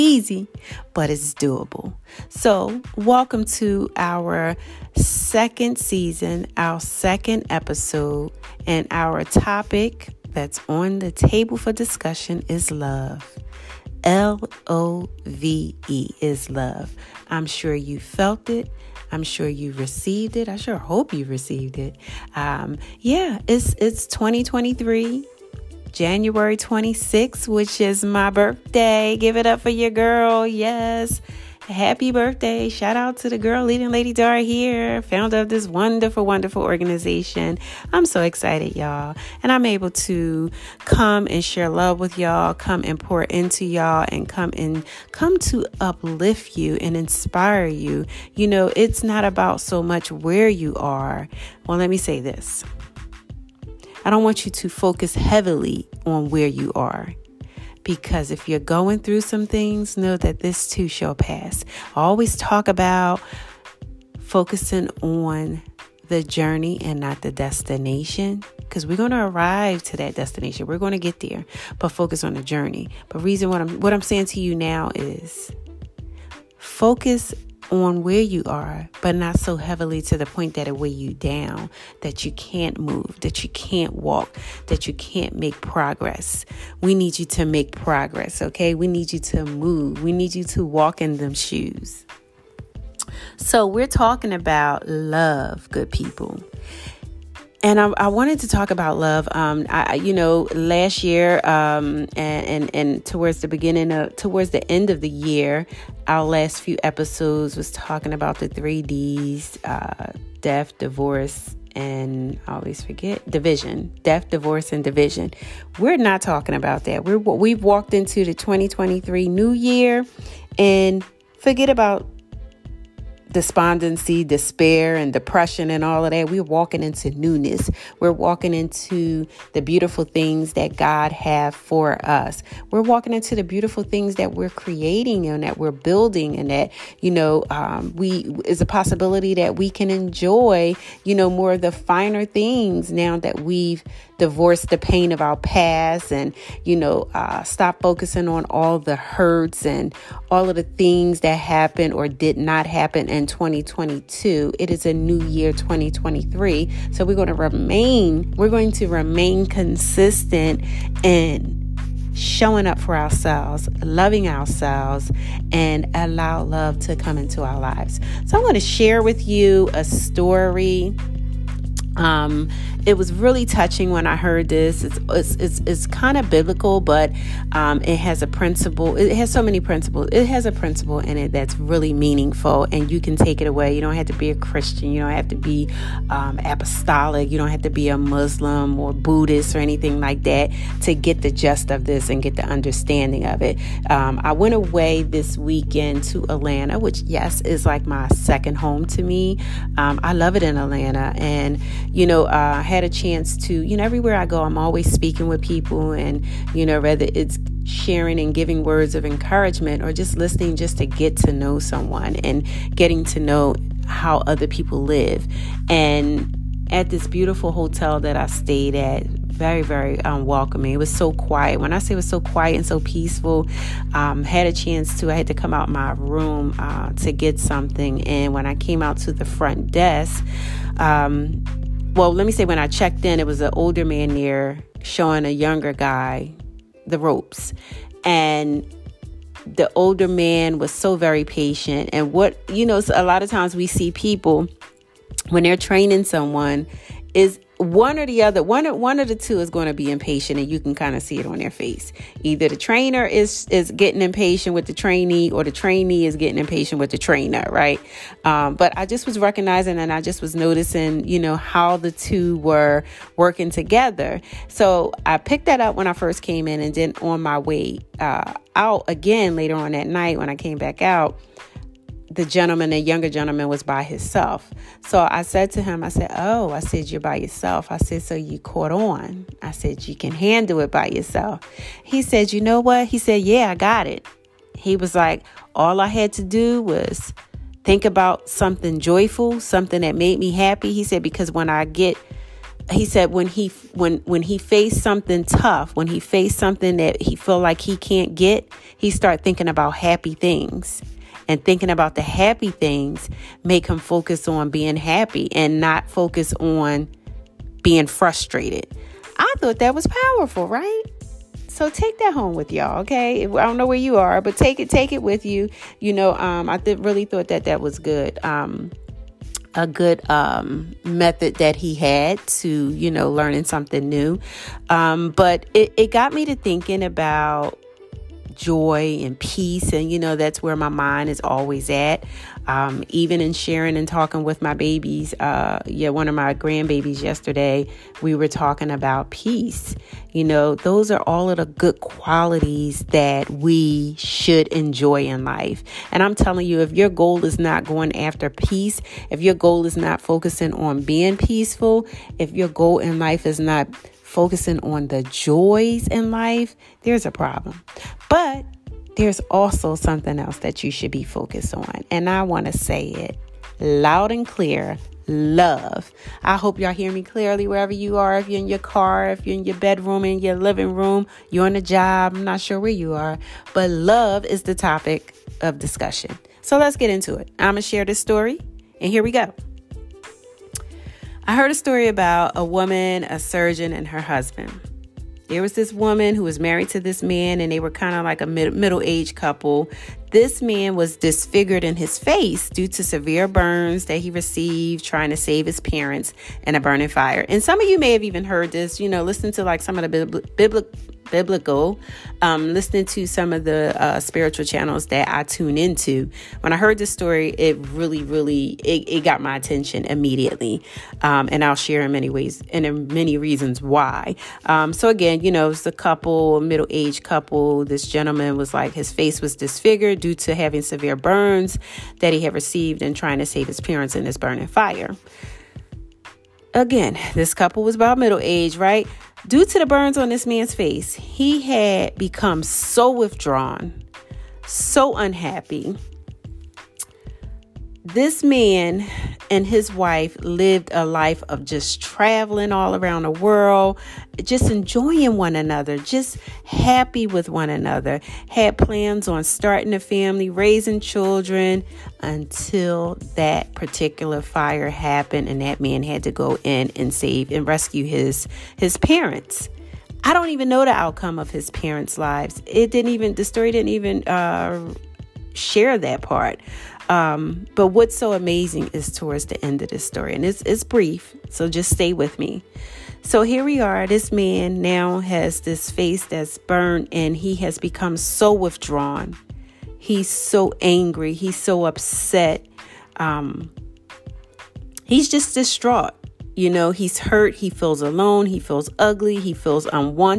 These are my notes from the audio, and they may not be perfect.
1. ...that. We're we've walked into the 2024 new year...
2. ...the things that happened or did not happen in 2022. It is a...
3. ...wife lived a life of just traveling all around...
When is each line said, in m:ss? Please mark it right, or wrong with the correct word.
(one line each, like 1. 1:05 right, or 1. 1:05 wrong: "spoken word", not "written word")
1. 1:56 wrong: "2023", not "2024"
2. 2:30 right
3. 7:19 right.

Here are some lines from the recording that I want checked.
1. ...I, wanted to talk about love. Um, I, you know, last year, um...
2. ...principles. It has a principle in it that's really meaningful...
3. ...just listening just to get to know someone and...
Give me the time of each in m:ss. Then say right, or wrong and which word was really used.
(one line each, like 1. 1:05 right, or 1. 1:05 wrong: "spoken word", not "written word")
1. 1:37 right
2. 2:59 right
3. 3:29 right.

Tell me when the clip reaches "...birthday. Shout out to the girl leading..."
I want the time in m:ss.
0:32.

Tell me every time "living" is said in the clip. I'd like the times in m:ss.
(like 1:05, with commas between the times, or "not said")
6:10.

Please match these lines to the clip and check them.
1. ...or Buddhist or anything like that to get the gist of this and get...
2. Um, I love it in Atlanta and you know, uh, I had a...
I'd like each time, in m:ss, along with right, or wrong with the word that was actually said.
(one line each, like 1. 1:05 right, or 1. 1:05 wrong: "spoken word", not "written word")
1. 3:08 right
2. 3:19 right.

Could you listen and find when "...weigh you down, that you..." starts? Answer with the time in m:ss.
1:20.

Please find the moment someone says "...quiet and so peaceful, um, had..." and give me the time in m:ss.
3:42.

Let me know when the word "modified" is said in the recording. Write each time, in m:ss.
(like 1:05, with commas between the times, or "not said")
not said.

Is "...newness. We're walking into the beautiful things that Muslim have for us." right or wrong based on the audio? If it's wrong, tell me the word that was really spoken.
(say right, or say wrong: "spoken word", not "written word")
wrong: "God", not "Muslim".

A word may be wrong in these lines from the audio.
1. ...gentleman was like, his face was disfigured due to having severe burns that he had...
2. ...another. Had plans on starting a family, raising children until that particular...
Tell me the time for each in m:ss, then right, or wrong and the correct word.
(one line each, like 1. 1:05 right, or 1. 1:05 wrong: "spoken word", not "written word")
1. 6:57 right
2. 7:27 right.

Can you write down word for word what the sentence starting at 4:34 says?
So I said to him, I said, Oh, I said, You're by yourself.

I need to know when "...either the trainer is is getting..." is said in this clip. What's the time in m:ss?
4:12.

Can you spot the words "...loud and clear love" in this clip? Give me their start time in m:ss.
6:03.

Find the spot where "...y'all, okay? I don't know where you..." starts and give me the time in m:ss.
5:12.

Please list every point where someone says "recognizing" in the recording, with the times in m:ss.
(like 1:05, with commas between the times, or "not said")
4:19.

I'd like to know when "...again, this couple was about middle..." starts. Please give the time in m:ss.
7:06.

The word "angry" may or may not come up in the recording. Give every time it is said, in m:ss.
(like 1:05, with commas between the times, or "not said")
8:00.